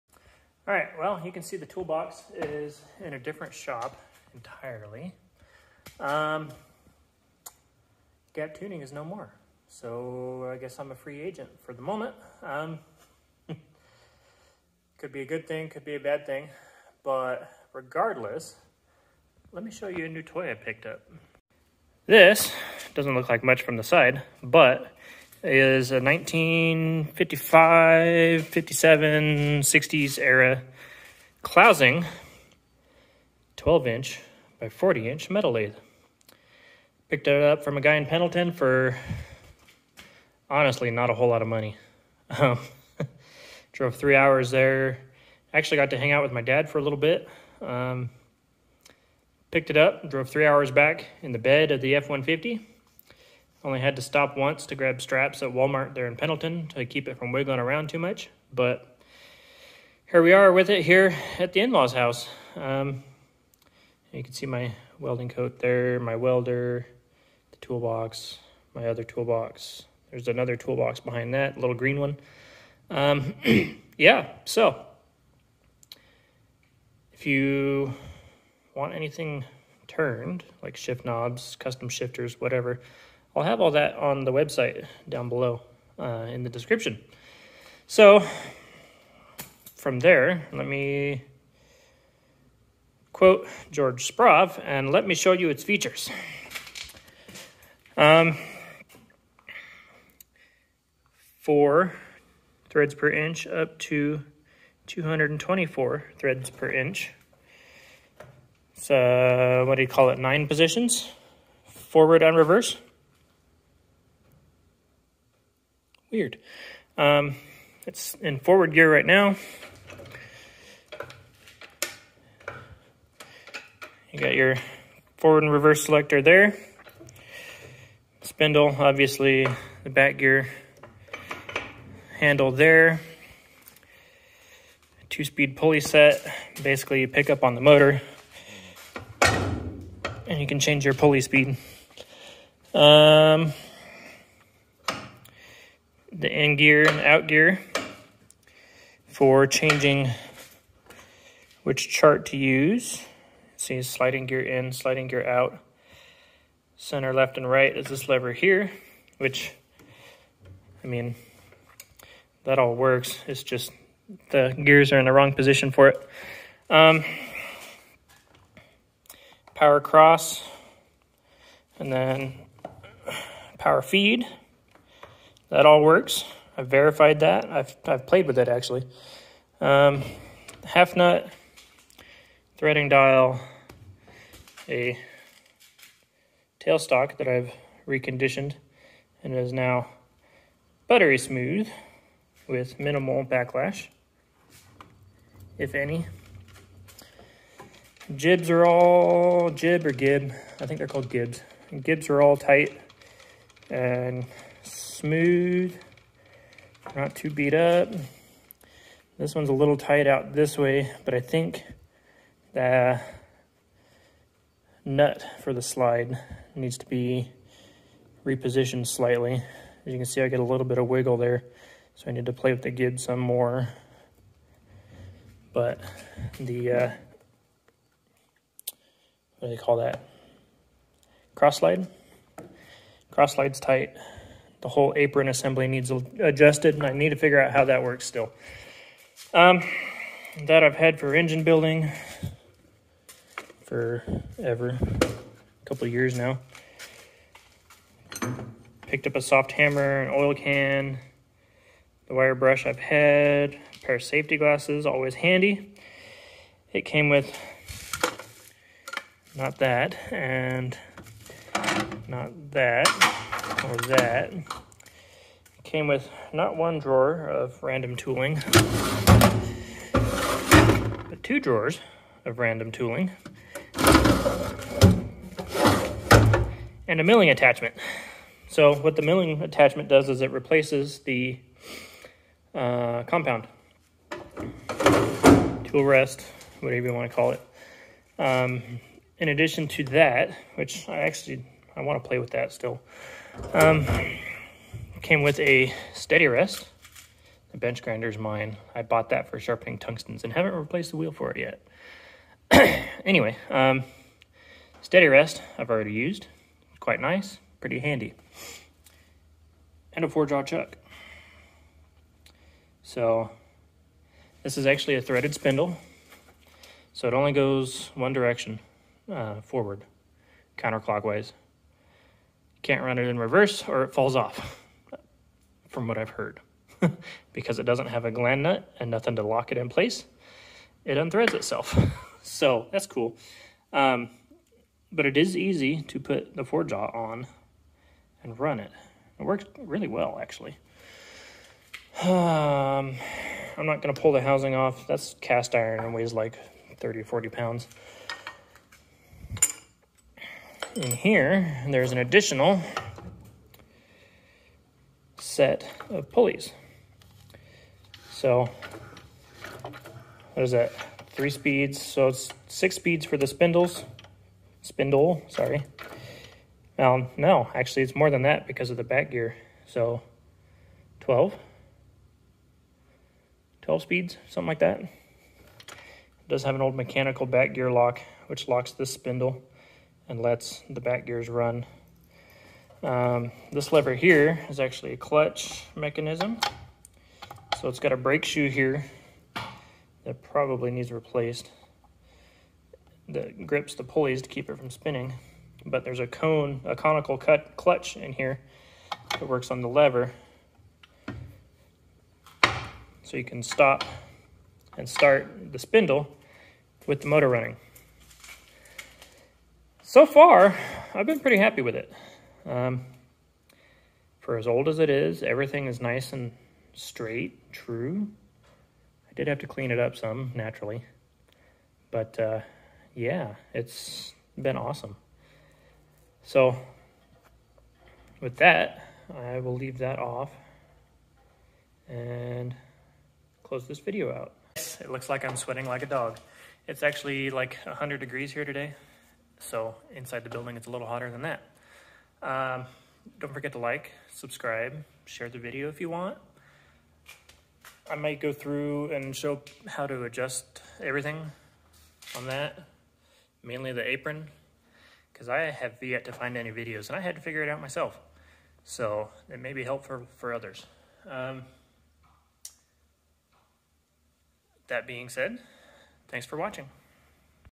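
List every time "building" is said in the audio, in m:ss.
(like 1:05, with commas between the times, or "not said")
4:01, 7:20.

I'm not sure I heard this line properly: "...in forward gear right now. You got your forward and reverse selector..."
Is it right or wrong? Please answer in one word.
right.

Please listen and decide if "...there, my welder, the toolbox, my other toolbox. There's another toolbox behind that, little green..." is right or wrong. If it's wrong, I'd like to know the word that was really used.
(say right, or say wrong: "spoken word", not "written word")
right.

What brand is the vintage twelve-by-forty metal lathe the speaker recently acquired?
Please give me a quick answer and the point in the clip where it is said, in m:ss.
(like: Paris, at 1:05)
Clausing, at 0:31.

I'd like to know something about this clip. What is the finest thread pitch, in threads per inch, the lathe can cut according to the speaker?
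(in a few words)
224.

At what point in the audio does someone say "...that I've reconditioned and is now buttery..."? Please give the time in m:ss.
3:07.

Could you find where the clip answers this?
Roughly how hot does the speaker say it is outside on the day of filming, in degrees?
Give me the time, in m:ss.
7:17.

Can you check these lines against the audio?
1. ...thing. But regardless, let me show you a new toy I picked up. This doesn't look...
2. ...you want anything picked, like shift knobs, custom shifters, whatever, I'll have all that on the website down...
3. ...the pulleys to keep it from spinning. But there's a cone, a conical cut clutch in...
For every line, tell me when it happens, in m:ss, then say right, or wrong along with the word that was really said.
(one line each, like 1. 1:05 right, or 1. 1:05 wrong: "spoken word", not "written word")
1. 0:16 right
2. 1:17 wrong: "turned", not "picked"
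3. 6:33 right.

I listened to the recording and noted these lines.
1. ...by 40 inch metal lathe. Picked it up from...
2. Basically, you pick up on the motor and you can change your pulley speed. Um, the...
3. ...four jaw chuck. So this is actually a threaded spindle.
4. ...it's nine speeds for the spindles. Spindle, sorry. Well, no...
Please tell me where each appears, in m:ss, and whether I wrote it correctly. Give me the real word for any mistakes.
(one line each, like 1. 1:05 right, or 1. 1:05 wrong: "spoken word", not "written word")
1. 0:34 right
2. 2:16 right
3. 5:10 right
4. 6:02 wrong: "six", not "nine".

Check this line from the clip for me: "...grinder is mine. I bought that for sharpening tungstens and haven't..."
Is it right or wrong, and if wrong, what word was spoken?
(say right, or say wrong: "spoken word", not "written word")
right.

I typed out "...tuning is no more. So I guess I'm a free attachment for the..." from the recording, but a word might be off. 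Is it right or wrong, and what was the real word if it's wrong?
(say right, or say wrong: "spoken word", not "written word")
wrong: "agent", not "attachment".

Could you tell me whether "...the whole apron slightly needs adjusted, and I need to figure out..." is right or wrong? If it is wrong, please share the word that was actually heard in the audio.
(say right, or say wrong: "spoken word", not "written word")
wrong: "assembly", not "slightly".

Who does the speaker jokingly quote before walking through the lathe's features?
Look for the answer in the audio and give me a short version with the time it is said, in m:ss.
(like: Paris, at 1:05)
George Sprave, at 1:33.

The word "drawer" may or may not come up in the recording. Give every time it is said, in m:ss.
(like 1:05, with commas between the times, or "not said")
4:26, 4:31.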